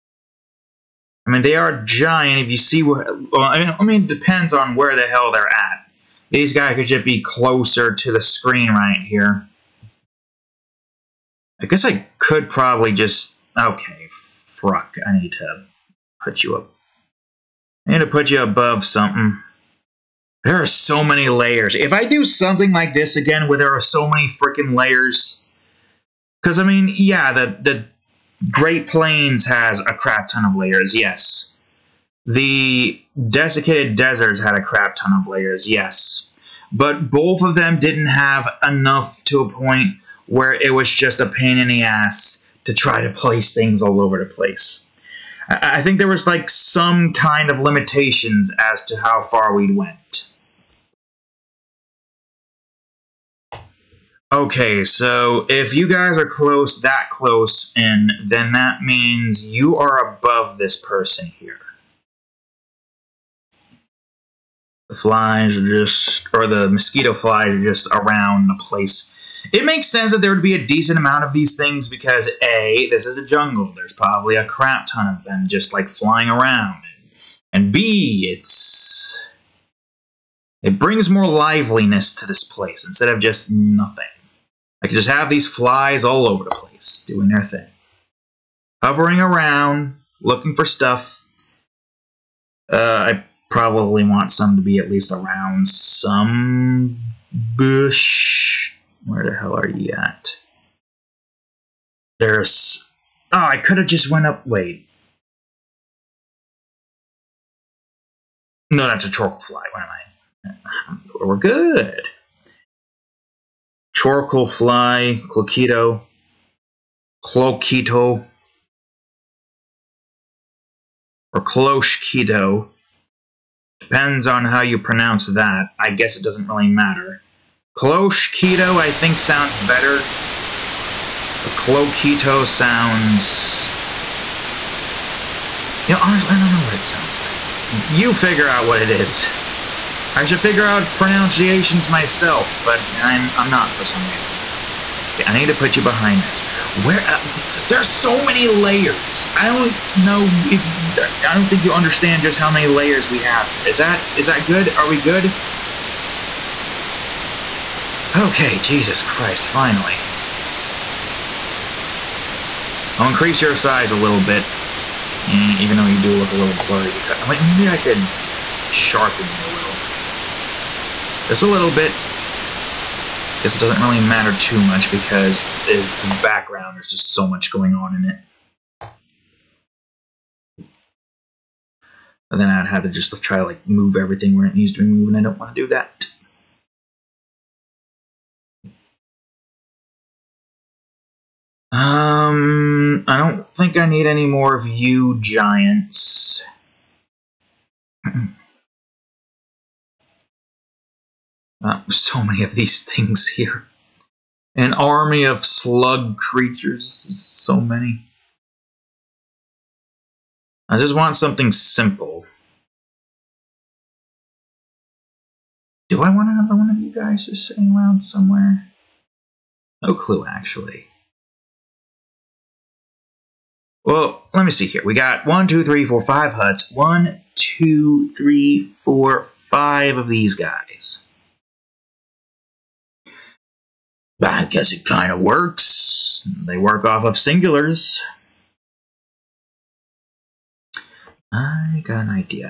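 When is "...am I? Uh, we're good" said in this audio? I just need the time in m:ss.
1:49.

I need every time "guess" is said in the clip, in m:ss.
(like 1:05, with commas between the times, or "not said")
0:11, 2:05, 3:54.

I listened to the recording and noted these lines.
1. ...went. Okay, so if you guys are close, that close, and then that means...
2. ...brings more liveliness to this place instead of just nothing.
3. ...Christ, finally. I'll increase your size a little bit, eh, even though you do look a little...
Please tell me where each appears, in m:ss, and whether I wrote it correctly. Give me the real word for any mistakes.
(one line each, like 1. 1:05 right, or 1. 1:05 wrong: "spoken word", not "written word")
1. 0:49 right
2. 1:20 right
3. 2:39 right.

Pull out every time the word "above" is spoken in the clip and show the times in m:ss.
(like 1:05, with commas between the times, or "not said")
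0:18, 1:00.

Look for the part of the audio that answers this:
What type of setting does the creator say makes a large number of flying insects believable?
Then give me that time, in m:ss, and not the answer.
1:13.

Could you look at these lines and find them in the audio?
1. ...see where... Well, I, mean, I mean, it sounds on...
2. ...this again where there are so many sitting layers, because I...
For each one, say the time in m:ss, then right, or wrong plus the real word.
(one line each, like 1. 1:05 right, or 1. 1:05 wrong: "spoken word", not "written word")
1. 0:02 wrong: "depends", not "sounds"
2. 0:22 wrong: "freaking", not "sitting".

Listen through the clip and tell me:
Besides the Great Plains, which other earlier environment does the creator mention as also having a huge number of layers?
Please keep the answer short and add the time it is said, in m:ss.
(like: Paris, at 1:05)
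Desiccated Deserts, at 0:33.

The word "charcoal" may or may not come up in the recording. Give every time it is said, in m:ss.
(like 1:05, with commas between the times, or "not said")
1:49, 1:53.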